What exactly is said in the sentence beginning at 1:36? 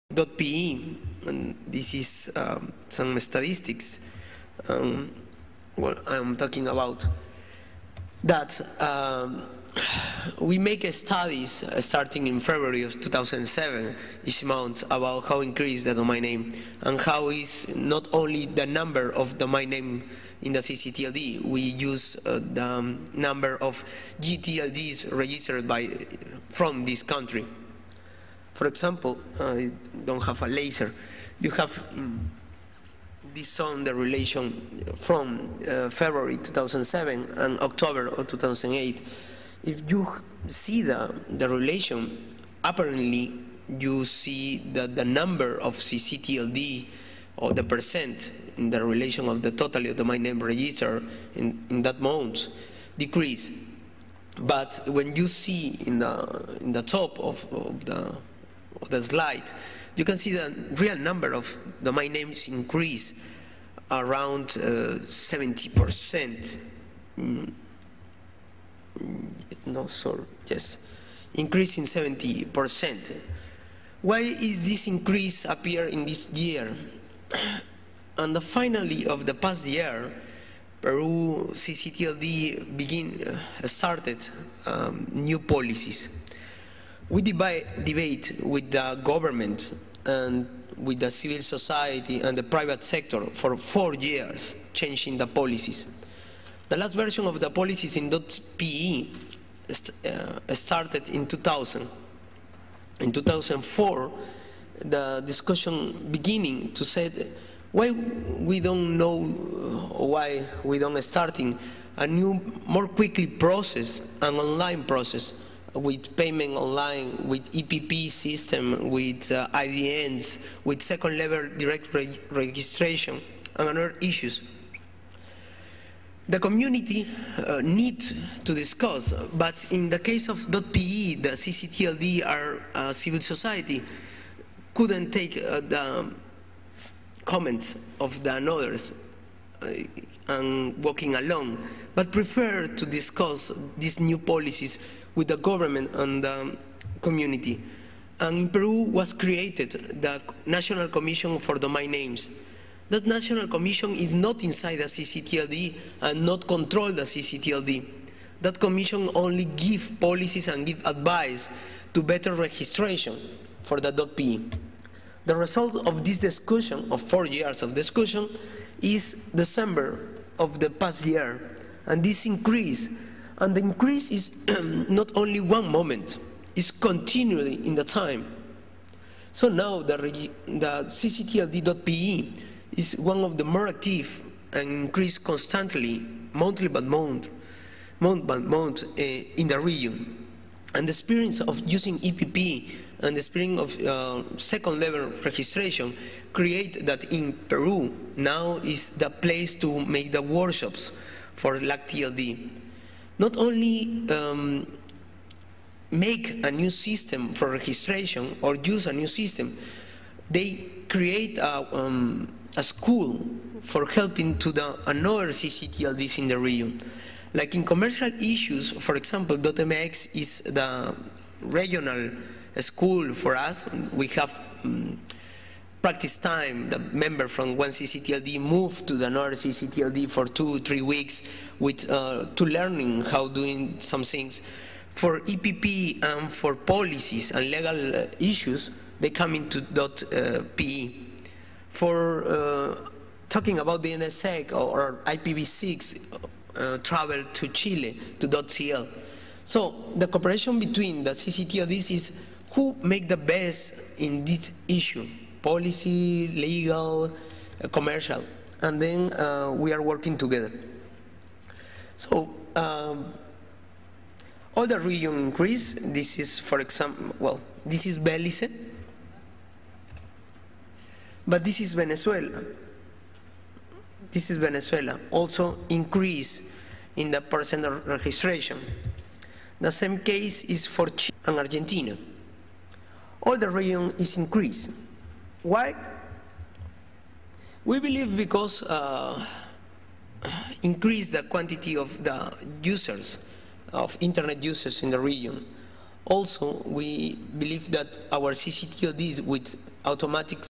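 The last version of the policies in .pe uh, started in 2000.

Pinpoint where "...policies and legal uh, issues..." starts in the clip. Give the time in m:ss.
3:56.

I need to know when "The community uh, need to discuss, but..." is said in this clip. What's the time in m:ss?
2:06.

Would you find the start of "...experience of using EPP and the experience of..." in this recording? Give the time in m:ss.
3:10.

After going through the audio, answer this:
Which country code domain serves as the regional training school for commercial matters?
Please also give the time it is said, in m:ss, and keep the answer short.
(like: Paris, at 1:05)
.mx, at 3:39.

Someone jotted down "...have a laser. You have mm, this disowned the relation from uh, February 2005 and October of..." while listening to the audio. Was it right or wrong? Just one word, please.
wrong.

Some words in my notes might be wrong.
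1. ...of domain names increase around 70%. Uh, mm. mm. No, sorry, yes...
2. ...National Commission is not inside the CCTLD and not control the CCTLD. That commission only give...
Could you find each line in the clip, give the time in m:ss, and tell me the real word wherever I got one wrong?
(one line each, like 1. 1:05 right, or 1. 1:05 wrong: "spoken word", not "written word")
1. 1:01 right
2. 2:33 right.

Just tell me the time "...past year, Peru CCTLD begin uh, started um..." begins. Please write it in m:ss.
1:19.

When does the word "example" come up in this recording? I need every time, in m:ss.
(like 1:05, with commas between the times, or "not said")
0:28, 3:38, 4:26.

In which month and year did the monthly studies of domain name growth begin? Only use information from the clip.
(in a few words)
February 2007.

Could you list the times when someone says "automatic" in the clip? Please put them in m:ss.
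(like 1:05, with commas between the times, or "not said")
4:59.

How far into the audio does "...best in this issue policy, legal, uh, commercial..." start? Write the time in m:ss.
4:13.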